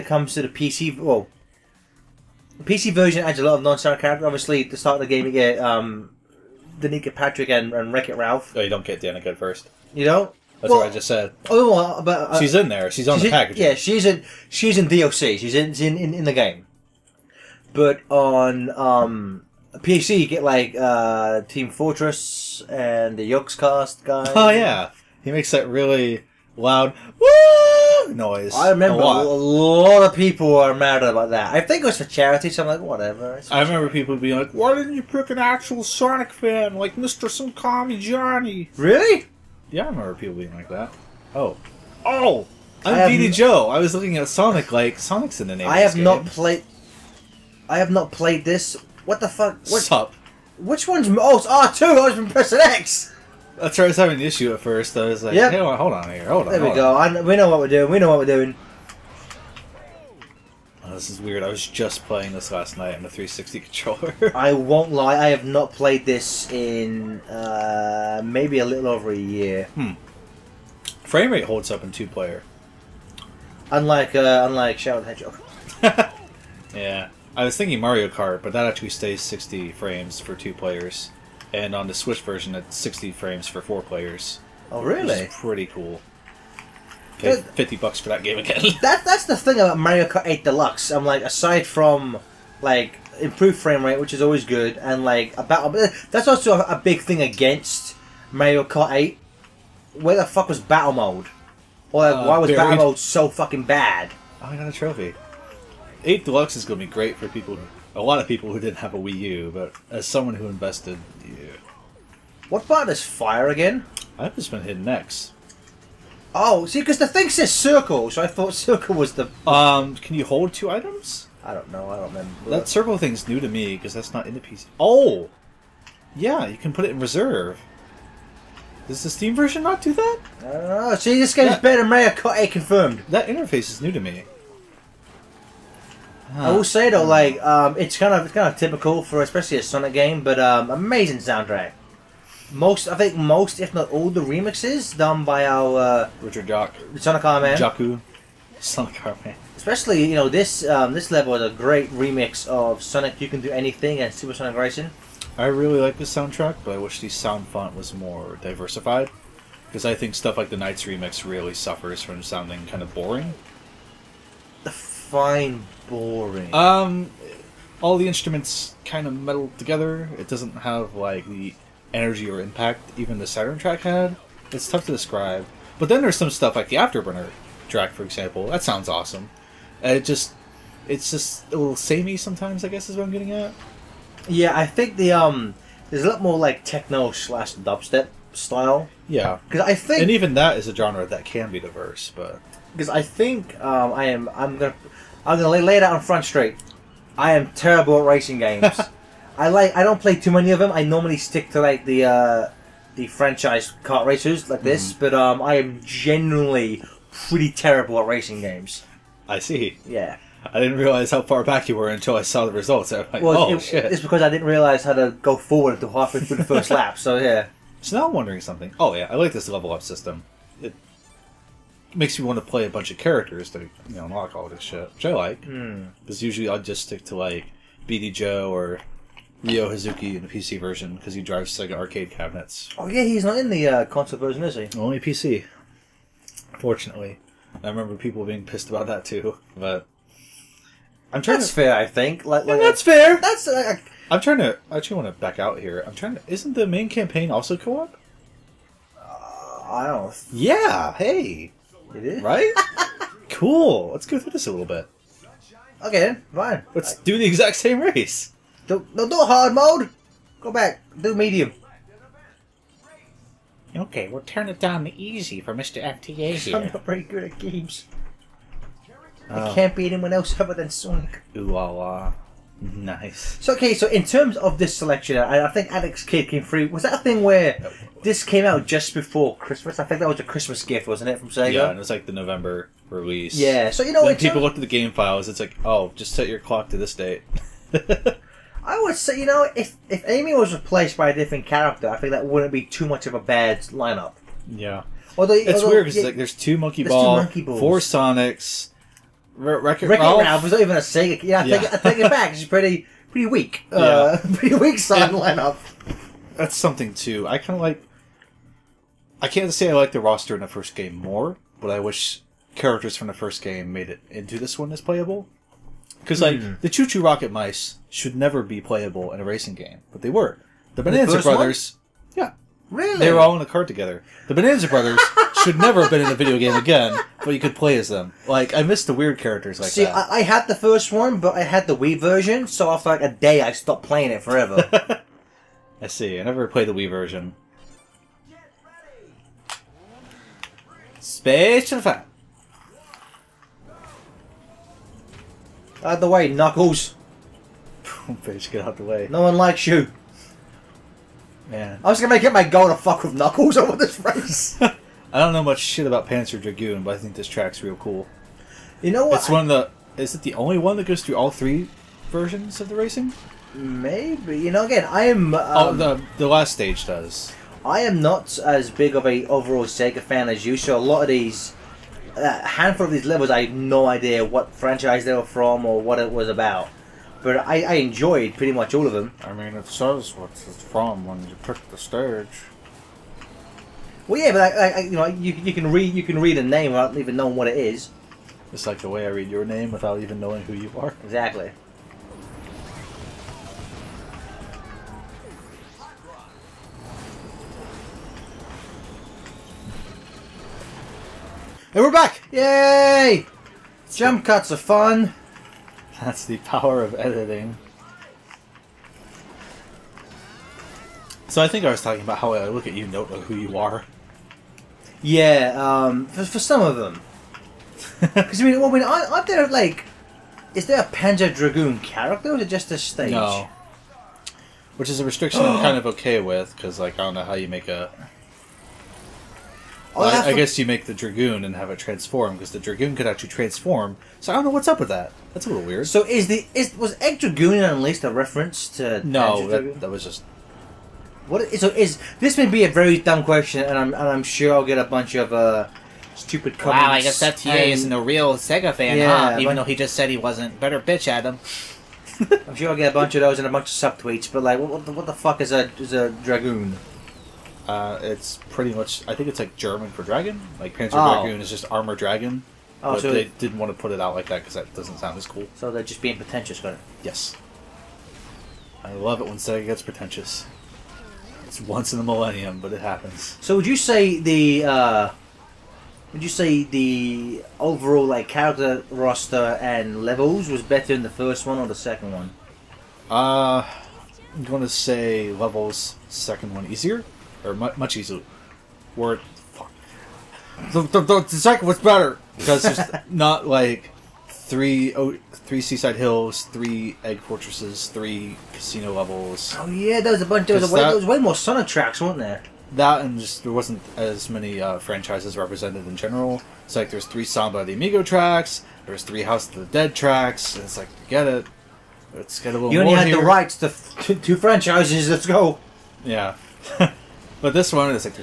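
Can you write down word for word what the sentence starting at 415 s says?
Yeah, um, for, for some of them.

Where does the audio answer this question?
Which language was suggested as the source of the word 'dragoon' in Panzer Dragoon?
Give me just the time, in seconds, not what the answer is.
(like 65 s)
459 s.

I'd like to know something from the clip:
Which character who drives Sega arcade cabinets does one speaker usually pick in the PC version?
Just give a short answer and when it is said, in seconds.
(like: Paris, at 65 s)
Ryo Hazuki, at 229 s.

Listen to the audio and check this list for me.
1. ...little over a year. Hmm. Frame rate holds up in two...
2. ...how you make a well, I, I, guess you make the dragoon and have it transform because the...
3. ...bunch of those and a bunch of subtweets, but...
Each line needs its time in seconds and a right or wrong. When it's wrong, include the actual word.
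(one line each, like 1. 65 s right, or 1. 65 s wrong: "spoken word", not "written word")
1. 68 s right
2. 427 s right
3. 452 s right.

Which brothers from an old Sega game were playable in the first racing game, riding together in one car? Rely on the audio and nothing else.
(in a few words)
Bonanza Brothers.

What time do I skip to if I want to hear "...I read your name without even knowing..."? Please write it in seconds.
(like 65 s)
389 s.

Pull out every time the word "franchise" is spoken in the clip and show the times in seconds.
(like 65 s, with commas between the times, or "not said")
203 s, 374 s, 504 s, 514 s.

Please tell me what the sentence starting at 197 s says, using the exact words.
I am terrible at racing games.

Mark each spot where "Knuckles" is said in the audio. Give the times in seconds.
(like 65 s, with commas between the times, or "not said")
346 s, 353 s.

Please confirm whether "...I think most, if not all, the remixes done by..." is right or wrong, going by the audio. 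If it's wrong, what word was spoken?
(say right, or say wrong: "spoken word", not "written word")
right.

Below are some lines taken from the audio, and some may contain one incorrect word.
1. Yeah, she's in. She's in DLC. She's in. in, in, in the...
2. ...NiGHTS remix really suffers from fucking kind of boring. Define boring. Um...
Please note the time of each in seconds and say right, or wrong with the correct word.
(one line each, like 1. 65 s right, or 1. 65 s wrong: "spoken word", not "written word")
1. 13 s right
2. 160 s wrong: "sounding", not "fucking".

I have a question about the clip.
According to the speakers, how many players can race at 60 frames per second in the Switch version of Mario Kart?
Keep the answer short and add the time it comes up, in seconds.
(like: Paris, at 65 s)
4, at 83 s.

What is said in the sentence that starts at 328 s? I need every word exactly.
Like I missed the weird characters like See, that.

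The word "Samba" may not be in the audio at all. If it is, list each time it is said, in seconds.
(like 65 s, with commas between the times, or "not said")
507 s.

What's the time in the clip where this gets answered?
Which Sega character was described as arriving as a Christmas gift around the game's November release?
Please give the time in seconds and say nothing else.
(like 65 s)
275 s.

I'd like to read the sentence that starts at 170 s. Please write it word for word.
It doesn't have like the energy or impact even the Saturn track had.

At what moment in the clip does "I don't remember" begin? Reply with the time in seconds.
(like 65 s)
121 s.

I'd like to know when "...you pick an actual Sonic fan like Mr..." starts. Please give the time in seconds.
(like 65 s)
34 s.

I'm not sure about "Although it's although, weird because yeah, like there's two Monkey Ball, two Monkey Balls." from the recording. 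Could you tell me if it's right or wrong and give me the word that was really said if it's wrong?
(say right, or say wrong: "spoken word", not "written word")
right.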